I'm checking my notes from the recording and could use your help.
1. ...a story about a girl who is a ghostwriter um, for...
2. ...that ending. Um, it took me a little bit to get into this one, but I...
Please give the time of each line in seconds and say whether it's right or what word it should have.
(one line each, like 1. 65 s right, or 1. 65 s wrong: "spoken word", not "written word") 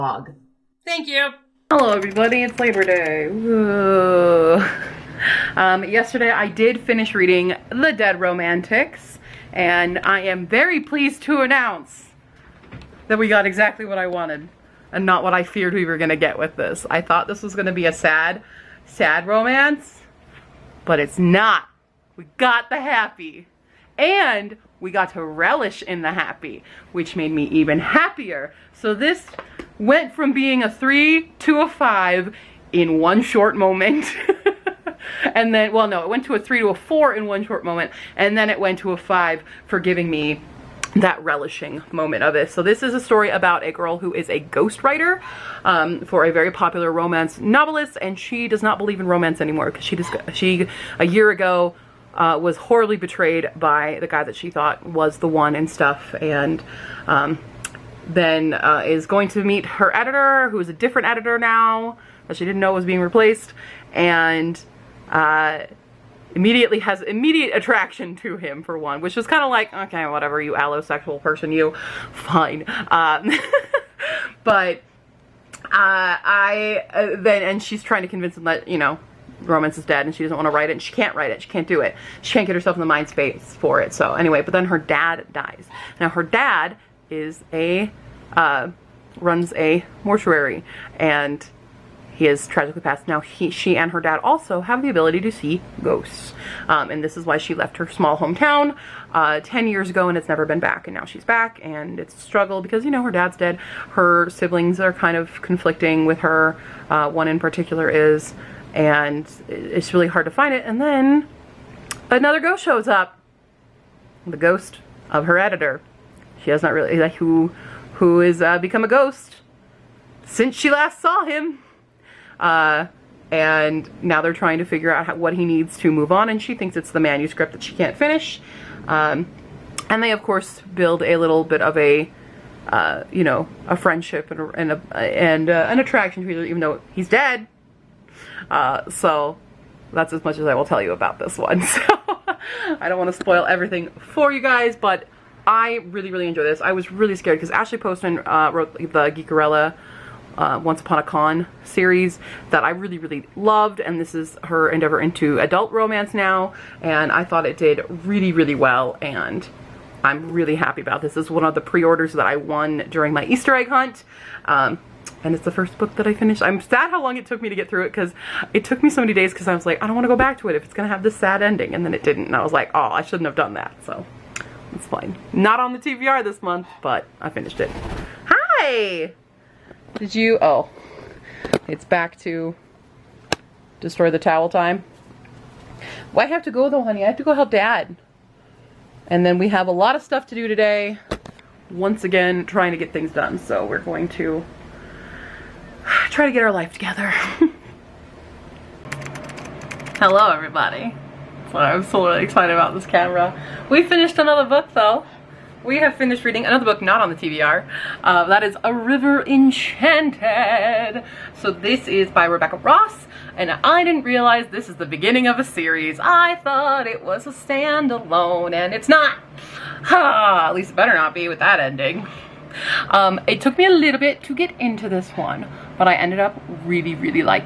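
1. 42 s right
2. 221 s right.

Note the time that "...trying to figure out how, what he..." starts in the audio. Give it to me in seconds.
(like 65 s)
124 s.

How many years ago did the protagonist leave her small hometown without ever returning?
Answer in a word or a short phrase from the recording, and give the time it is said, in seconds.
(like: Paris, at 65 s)
10, at 99 s.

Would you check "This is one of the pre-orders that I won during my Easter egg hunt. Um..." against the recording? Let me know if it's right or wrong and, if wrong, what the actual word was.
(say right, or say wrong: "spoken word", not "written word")
right.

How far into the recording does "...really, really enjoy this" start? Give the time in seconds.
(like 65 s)
145 s.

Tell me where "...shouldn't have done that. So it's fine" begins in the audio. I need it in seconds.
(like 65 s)
173 s.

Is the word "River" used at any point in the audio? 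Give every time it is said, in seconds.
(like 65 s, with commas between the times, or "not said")
208 s.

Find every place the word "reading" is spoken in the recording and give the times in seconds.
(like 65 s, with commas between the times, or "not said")
7 s, 206 s.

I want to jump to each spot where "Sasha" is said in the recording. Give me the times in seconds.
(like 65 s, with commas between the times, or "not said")
not said.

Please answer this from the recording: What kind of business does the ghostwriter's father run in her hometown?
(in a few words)
A mortuary.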